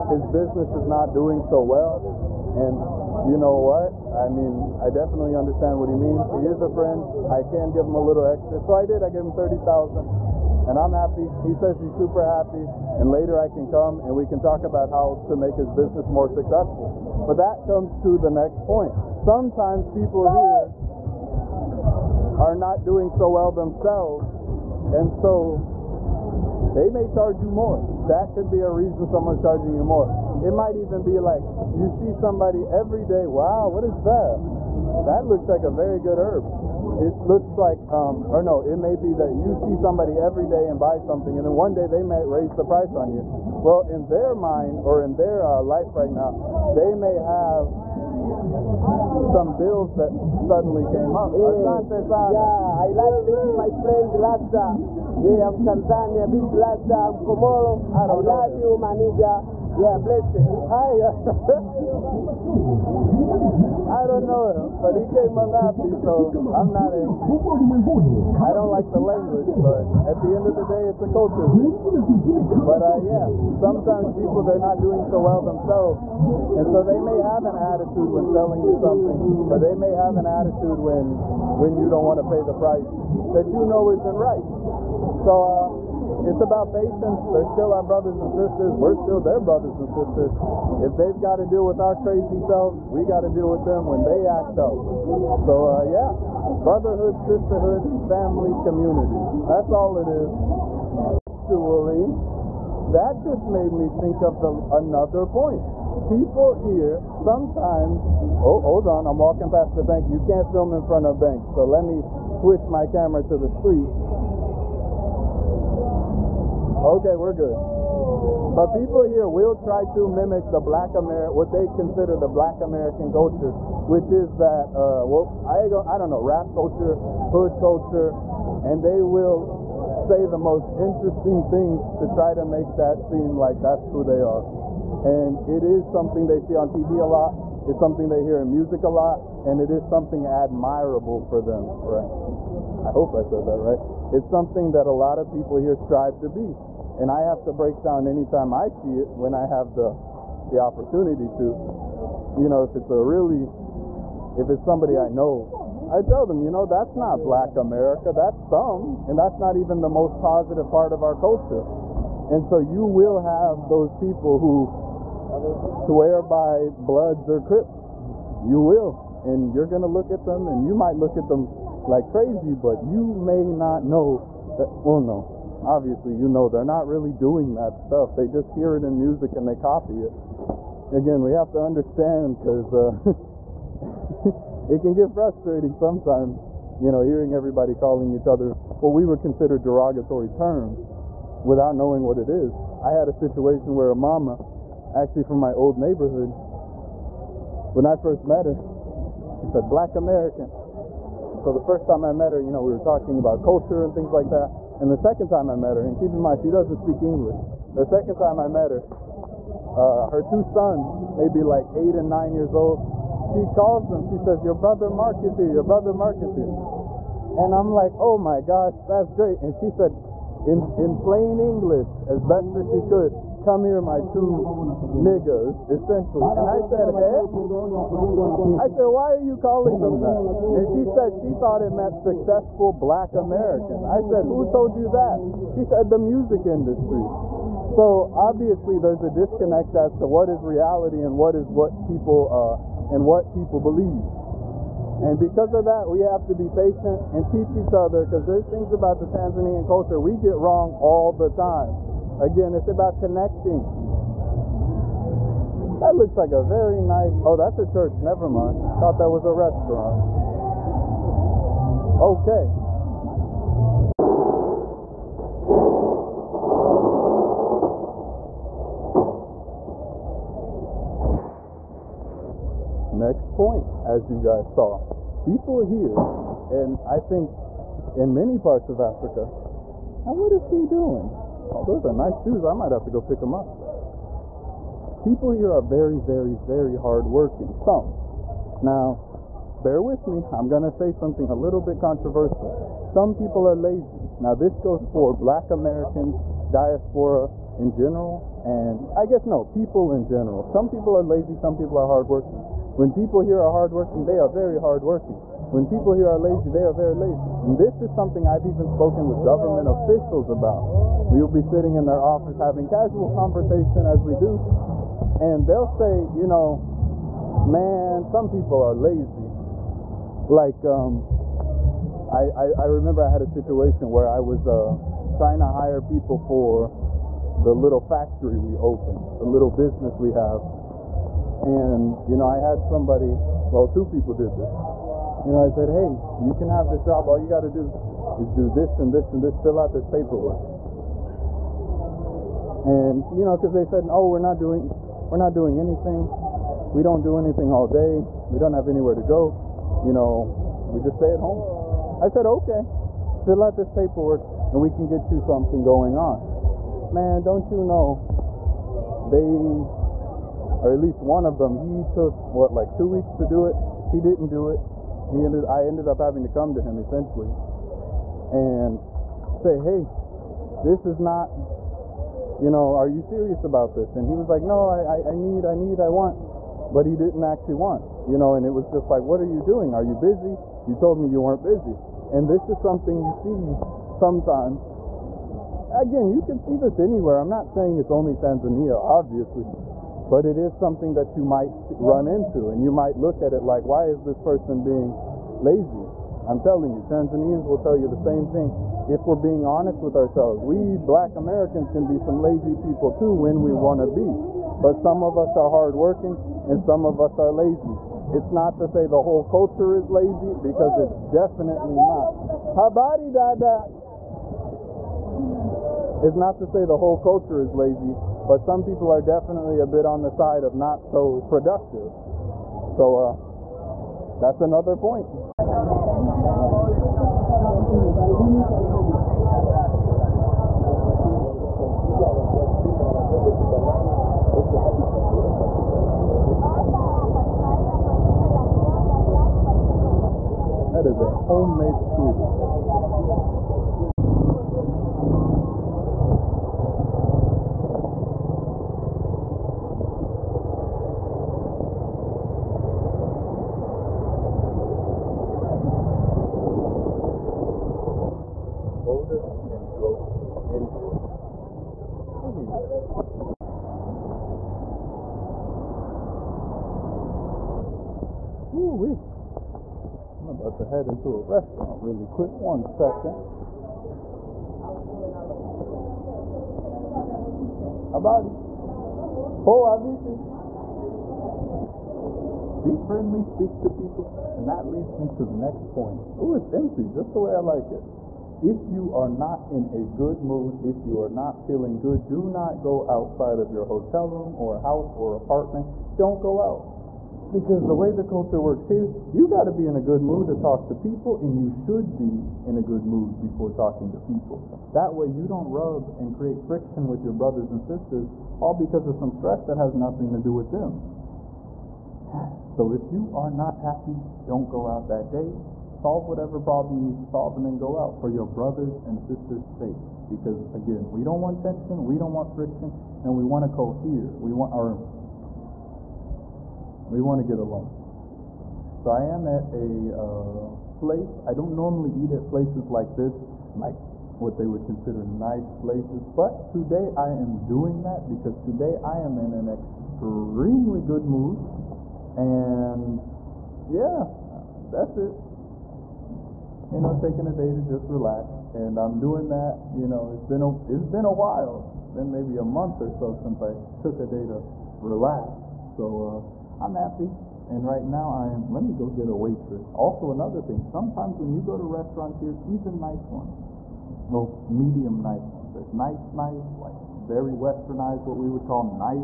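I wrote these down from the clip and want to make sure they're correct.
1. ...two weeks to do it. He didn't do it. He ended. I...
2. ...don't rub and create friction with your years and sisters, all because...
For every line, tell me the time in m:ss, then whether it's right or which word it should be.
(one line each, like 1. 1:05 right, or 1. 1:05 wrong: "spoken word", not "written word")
1. 6:02 right
2. 8:25 wrong: "brothers", not "years".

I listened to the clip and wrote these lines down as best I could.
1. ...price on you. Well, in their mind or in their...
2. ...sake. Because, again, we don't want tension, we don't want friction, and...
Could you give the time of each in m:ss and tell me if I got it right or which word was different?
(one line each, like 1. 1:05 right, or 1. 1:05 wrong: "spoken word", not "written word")
1. 0:42 right
2. 8:39 right.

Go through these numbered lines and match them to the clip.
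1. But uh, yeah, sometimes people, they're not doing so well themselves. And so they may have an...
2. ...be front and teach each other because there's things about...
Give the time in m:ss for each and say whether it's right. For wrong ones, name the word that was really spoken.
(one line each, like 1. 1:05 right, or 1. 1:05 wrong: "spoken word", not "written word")
1. 1:12 right
2. 4:06 wrong: "patient", not "front".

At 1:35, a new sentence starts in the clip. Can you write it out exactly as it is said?
So uh, yeah, brotherhood, sisterhood, family, community.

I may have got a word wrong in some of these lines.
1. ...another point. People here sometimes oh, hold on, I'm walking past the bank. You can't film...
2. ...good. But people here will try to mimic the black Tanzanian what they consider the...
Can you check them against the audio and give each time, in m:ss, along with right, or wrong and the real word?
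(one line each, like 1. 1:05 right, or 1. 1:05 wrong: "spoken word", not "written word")
1. 1:44 right
2. 1:57 wrong: "Amer", not "Tanzanian".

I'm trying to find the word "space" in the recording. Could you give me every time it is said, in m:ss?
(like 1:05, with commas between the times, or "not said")
not said.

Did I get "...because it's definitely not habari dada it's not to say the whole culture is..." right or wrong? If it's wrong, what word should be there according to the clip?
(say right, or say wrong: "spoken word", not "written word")
right.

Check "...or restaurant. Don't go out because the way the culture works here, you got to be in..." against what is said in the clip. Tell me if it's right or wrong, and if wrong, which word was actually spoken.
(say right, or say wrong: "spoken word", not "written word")
wrong: "apartment", not "restaurant".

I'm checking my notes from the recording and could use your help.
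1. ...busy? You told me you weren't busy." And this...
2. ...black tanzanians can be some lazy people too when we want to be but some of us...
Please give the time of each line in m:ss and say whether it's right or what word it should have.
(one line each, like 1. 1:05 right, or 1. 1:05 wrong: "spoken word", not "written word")
1. 6:19 right
2. 6:40 wrong: "americans", not "tanzanians".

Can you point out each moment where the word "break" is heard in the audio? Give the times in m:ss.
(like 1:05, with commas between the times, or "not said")
2:27.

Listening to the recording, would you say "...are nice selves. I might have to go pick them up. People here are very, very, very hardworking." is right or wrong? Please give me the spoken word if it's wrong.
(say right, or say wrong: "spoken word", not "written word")
wrong: "shoes", not "selves".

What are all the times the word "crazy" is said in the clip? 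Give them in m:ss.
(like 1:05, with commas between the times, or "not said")
1:31, 2:52.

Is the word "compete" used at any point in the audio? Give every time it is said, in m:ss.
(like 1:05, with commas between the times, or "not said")
not said.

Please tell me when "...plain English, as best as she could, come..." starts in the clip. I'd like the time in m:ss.
3:40.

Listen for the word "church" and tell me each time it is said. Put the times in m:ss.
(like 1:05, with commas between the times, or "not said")
4:17.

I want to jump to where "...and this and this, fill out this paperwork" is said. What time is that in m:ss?
5:38.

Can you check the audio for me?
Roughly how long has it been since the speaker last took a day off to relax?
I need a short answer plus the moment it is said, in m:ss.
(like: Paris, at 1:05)
a month, at 9:12.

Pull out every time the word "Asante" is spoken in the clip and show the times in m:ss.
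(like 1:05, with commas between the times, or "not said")
0:51.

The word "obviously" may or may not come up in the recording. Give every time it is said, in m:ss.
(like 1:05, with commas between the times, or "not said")
2:55, 3:58, 6:28.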